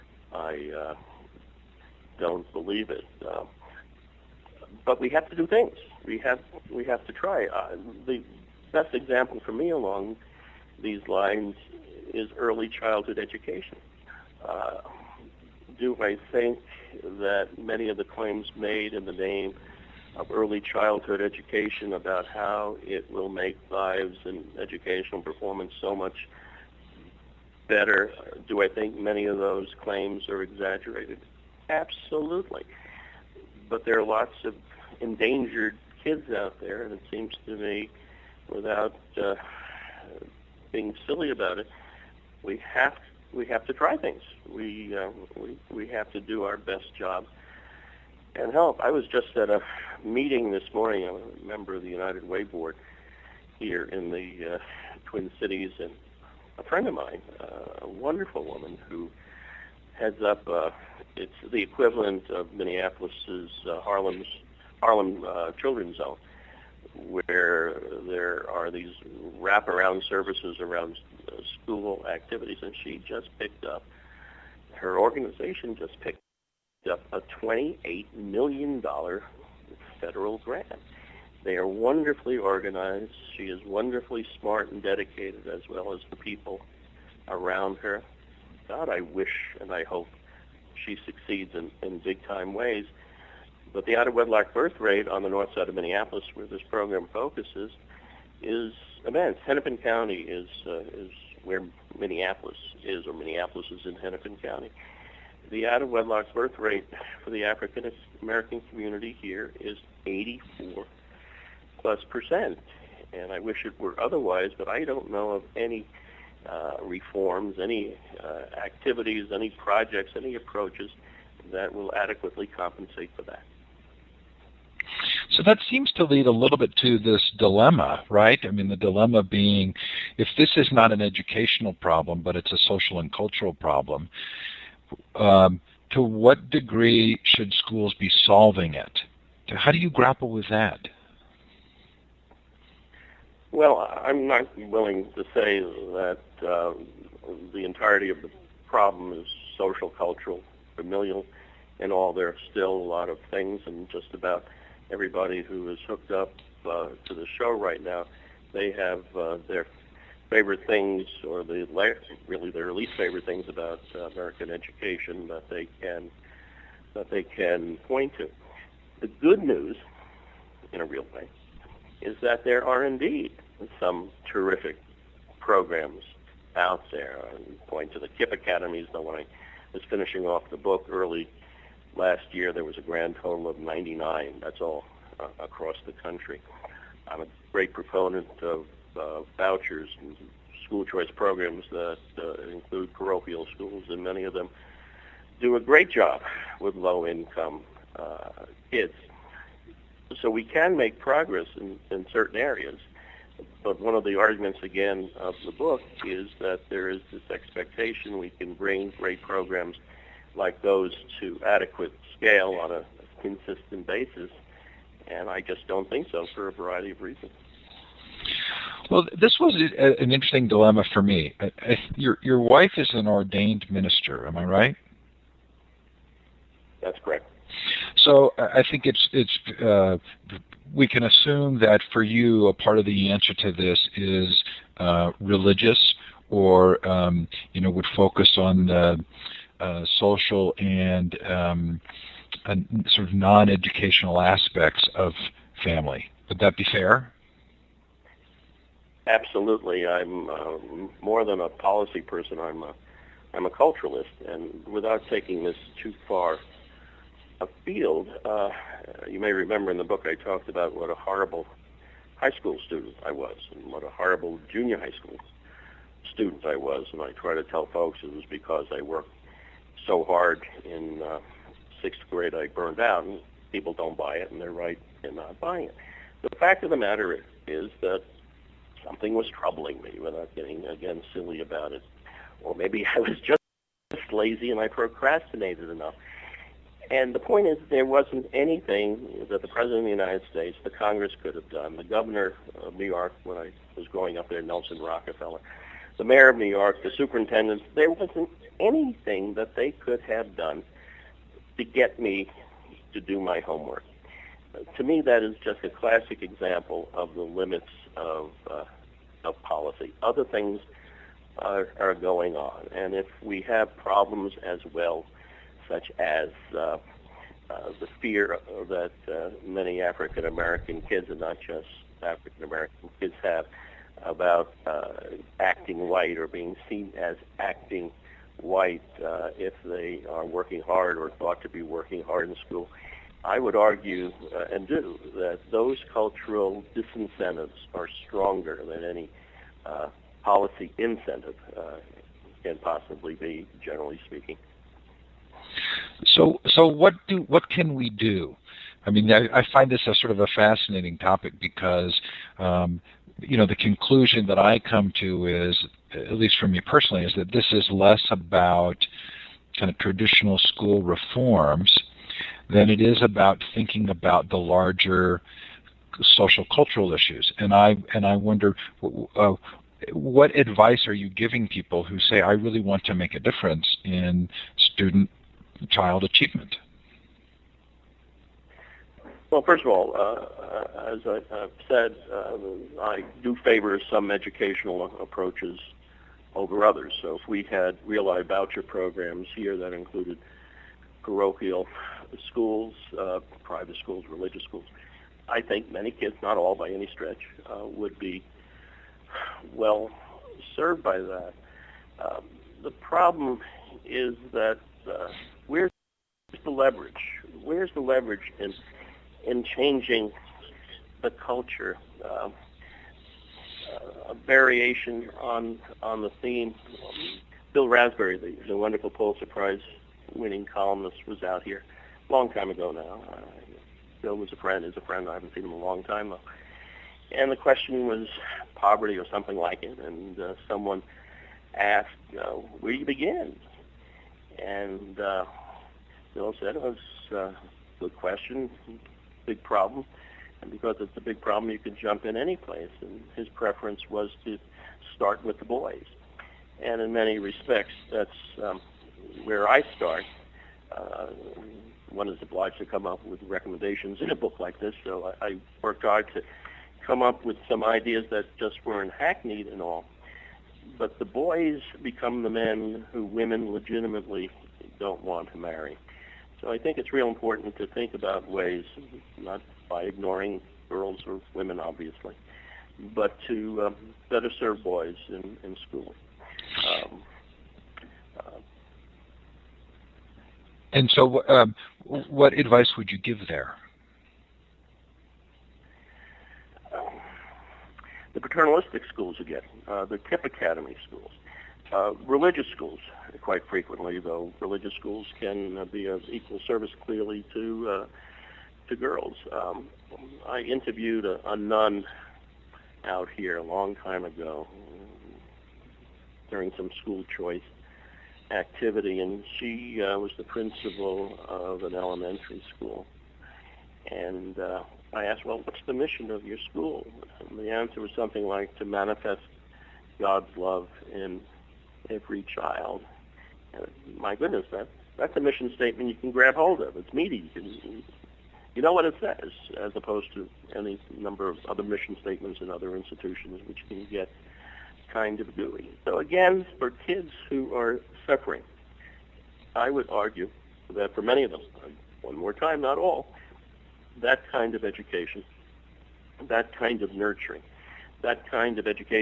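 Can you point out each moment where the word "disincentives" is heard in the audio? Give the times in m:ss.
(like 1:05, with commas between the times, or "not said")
5:36.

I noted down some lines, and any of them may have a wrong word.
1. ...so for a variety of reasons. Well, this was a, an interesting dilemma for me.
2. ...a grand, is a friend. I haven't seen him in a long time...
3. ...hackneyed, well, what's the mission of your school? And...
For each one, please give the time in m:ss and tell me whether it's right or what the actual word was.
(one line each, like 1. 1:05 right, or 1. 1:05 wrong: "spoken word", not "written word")
1. 3:36 right
2. 7:04 wrong: "friend", not "grand"
3. 8:35 wrong: "asked", not "hackneyed".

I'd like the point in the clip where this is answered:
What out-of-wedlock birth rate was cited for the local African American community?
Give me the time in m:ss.
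1:50.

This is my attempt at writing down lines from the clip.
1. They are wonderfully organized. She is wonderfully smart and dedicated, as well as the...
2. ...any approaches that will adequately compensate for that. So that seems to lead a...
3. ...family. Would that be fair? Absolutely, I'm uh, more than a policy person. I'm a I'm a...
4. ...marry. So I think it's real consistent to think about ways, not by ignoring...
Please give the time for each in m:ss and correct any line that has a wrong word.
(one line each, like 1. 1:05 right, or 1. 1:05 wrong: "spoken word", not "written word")
1. 1:21 right
2. 2:00 right
3. 4:05 right
4. 7:45 wrong: "important", not "consistent".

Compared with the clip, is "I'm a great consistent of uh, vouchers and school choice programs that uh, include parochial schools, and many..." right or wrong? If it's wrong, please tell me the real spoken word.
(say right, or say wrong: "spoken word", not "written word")
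wrong: "proponent", not "consistent".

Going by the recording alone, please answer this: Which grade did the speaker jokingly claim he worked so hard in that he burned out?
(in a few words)
sixth grade.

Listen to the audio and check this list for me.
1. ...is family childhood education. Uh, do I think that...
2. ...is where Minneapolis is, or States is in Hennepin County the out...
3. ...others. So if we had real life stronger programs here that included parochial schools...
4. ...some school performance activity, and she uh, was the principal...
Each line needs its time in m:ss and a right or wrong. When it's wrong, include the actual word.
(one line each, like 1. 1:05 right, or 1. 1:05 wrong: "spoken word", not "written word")
1. 0:12 wrong: "early", not "family"
2. 1:40 wrong: "Minneapolis", not "States"
3. 6:26 wrong: "voucher", not "stronger"
4. 8:26 wrong: "choice", not "performance".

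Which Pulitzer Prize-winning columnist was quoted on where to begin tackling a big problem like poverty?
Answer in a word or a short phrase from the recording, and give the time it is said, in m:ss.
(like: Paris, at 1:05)
Bill Raspberry, at 6:57.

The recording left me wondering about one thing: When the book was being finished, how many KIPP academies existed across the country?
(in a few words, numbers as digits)
99.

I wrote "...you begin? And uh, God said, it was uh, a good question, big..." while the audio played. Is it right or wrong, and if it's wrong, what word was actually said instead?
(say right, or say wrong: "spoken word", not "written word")
wrong: "Bill", not "God".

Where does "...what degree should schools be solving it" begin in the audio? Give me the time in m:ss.
2:16.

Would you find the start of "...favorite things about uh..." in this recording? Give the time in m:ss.
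2:42.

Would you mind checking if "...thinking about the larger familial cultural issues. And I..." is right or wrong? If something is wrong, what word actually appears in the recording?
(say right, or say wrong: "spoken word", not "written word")
wrong: "social", not "familial".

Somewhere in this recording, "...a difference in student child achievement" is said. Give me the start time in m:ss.
6:13.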